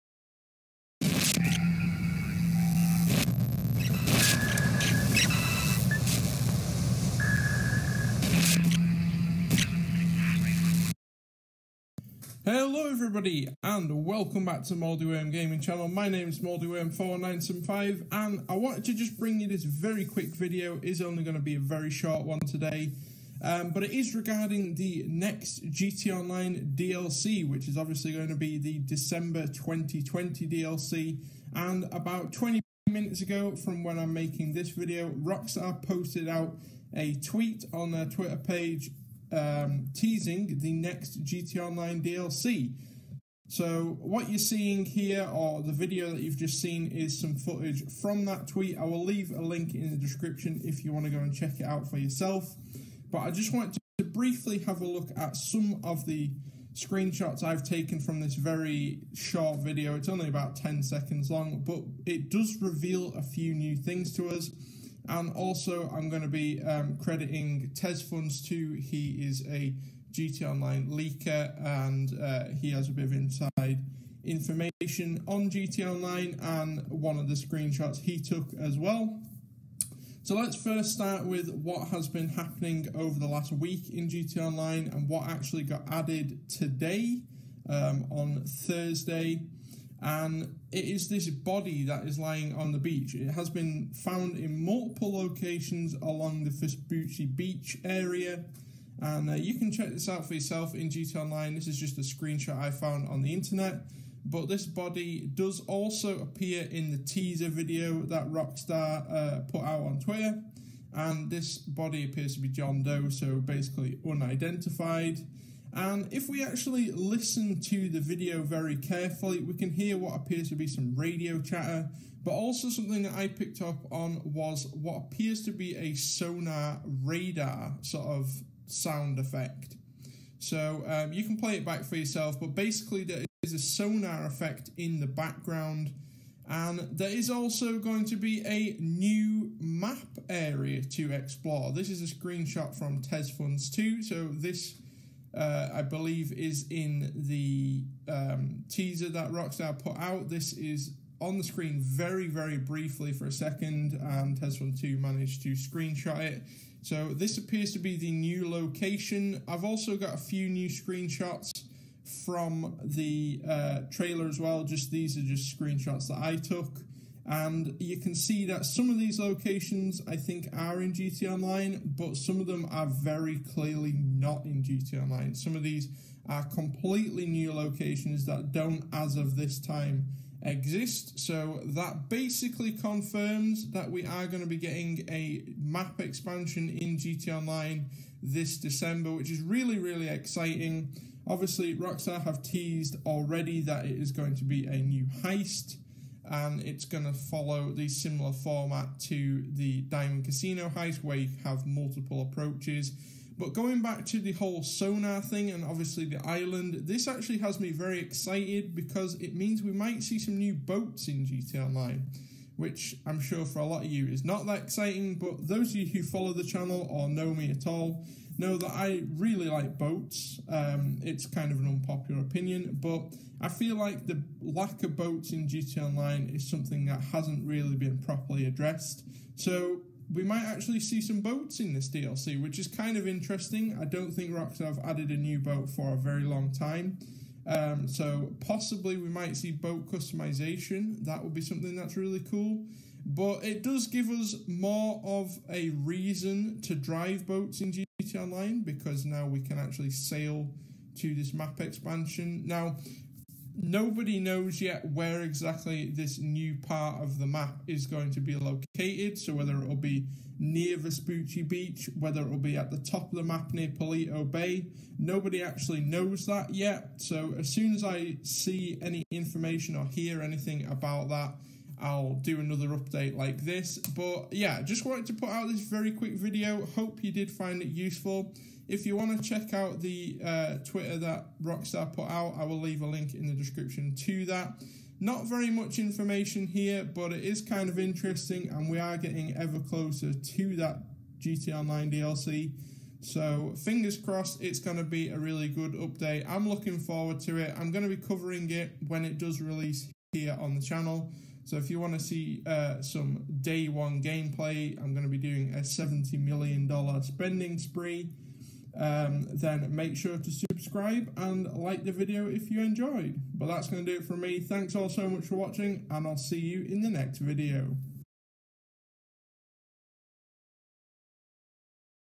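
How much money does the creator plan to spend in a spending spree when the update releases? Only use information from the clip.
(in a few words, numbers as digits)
$70 million.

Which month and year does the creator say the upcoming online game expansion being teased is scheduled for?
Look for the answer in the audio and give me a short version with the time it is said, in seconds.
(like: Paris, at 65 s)
December 2020, at 28 s.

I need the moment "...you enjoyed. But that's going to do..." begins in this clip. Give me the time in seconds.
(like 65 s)
312 s.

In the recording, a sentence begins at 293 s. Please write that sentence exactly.
So, fingers crossed, it's going to be a really good update.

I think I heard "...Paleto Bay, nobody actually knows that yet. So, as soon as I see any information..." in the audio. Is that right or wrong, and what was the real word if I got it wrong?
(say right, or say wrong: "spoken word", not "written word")
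right.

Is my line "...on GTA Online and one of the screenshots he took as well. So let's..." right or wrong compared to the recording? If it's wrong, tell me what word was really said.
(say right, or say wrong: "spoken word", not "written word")
right.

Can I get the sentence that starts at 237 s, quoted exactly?
Um, so possibly we might see boat customization.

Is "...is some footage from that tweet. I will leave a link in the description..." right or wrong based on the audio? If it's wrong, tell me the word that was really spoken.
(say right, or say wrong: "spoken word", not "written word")
right.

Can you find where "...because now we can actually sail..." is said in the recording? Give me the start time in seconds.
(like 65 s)
248 s.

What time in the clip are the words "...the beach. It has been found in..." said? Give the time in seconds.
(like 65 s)
92 s.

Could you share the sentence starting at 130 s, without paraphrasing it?
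So um, you can play it back for yourself, but basically there is a sonar effect in the background.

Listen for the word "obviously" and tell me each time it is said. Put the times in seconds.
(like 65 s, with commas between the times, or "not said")
27 s, 191 s, 205 s.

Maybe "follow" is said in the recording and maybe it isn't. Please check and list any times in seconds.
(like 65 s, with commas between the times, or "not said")
197 s, 216 s.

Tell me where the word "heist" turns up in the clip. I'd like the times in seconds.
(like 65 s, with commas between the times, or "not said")
195 s, 200 s.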